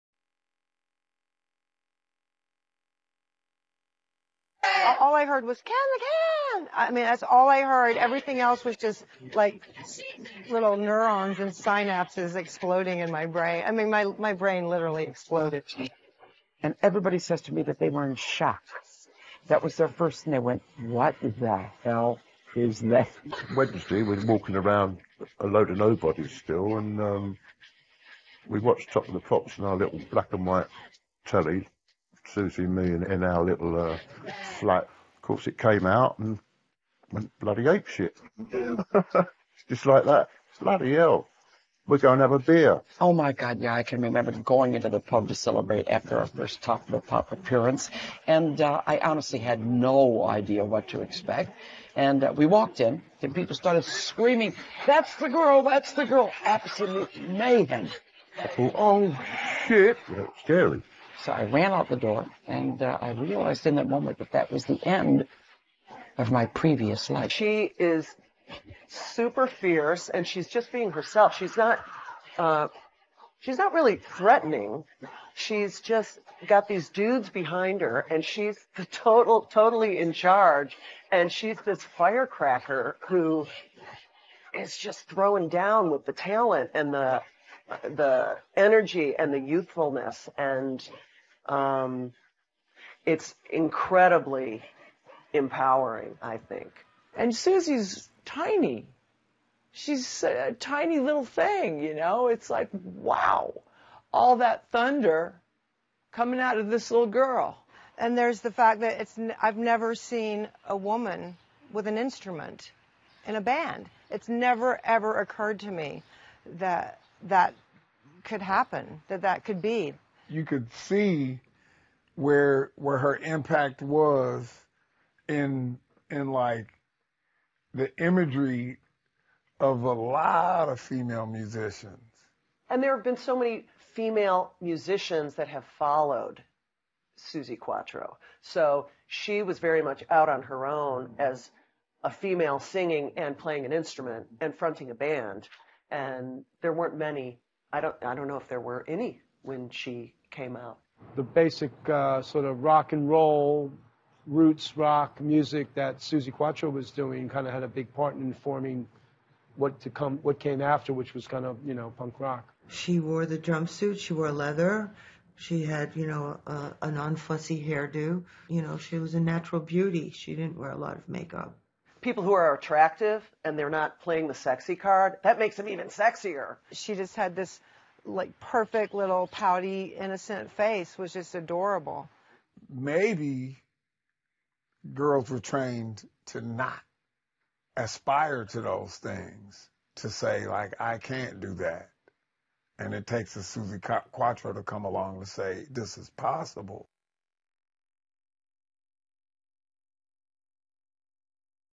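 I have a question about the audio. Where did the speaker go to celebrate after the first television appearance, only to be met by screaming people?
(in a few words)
the pub.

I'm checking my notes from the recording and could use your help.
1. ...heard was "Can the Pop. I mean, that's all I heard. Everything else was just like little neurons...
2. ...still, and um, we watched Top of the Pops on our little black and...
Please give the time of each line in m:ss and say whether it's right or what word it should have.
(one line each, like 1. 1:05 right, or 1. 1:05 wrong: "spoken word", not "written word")
1. 0:05 wrong: "Can", not "Pop"
2. 0:26 right.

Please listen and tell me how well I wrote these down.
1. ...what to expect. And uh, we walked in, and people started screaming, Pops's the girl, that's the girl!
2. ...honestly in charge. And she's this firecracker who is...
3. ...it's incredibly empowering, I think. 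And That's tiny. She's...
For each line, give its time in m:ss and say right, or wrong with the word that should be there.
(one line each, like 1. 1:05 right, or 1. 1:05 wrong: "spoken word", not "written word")
1. 0:50 wrong: "That", not "Pops"
2. 1:19 wrong: "totally", not "honestly"
3. 1:33 wrong: "Suzi", not "That".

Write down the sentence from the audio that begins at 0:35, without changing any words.
Of course, it came out and went bloody ape shit.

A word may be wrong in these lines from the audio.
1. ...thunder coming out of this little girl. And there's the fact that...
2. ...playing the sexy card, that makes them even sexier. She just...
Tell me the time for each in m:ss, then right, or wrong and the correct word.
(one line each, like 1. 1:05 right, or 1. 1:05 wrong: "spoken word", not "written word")
1. 1:44 right
2. 2:54 right.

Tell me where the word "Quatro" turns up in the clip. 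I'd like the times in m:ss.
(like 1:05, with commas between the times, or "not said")
2:17, 2:36, 3:14.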